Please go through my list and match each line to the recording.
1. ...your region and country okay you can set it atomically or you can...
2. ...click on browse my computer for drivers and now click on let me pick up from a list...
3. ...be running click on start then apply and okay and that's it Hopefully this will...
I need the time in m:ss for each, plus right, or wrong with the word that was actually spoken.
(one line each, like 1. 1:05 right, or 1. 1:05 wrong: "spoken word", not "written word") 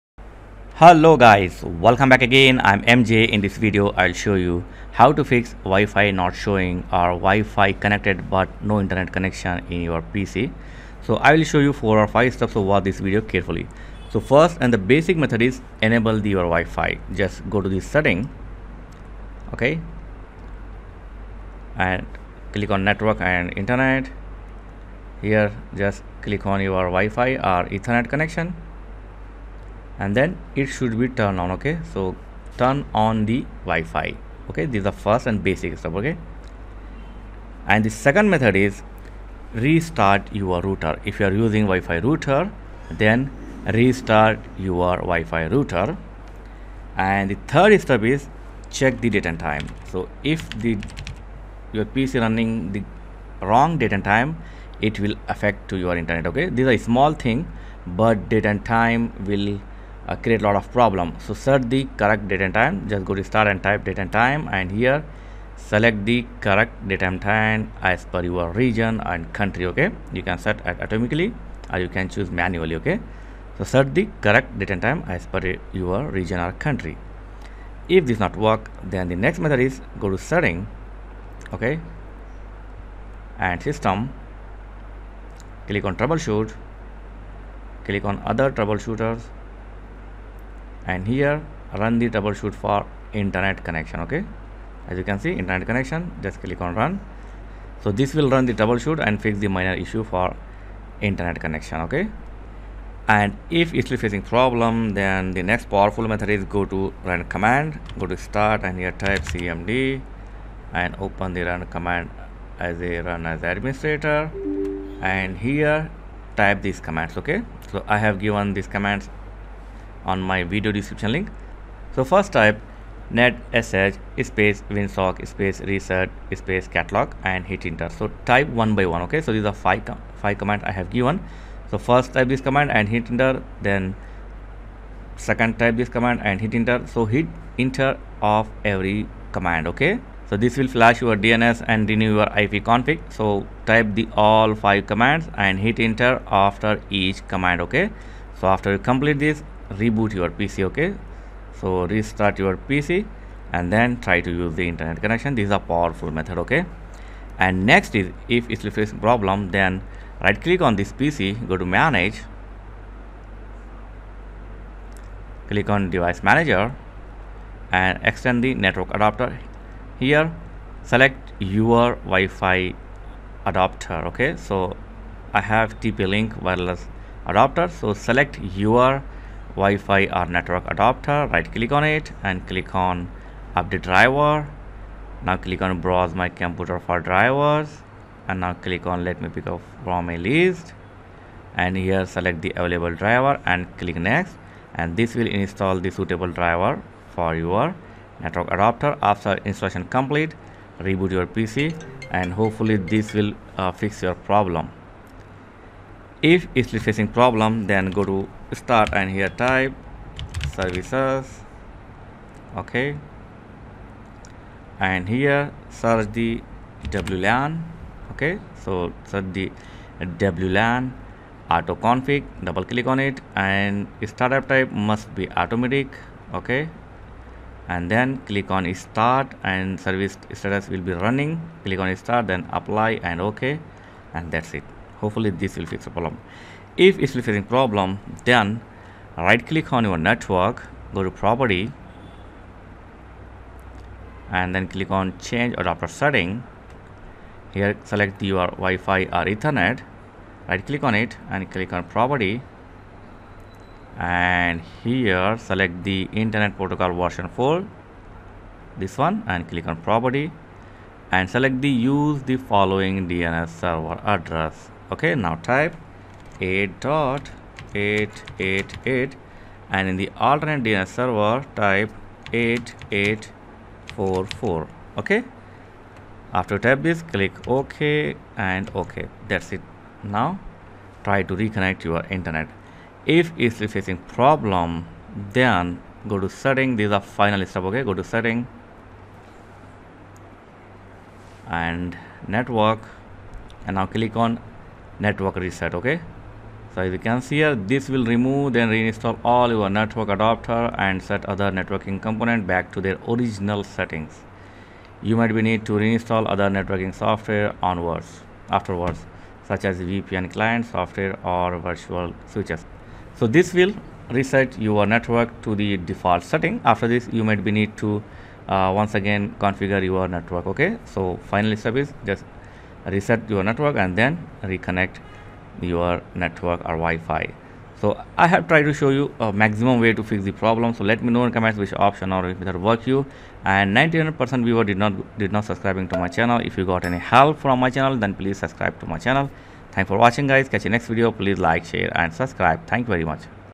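1. 1:08 right
2. 3:05 right
3. 3:50 right.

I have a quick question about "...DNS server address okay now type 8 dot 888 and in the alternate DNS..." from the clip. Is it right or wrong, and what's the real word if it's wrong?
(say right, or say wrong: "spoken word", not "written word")
right.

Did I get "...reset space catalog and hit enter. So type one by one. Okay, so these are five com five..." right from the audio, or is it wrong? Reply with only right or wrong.
right.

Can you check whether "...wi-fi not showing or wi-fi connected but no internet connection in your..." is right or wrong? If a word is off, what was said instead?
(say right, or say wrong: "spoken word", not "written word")
right.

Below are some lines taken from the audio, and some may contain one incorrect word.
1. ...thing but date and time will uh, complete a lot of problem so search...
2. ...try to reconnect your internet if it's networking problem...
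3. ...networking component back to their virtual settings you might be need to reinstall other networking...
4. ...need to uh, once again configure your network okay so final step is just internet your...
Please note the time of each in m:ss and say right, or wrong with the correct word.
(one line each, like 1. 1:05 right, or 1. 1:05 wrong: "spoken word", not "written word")
1. 0:57 wrong: "create", not "complete"
2. 4:41 wrong: "facing", not "networking"
3. 5:01 wrong: "original", not "virtual"
4. 5:17 wrong: "reset", not "internet".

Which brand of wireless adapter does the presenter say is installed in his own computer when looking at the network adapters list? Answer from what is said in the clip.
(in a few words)
TP-Link.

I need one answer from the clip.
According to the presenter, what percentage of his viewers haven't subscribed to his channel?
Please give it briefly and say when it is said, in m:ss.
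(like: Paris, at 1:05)
99 percent, at 5:33.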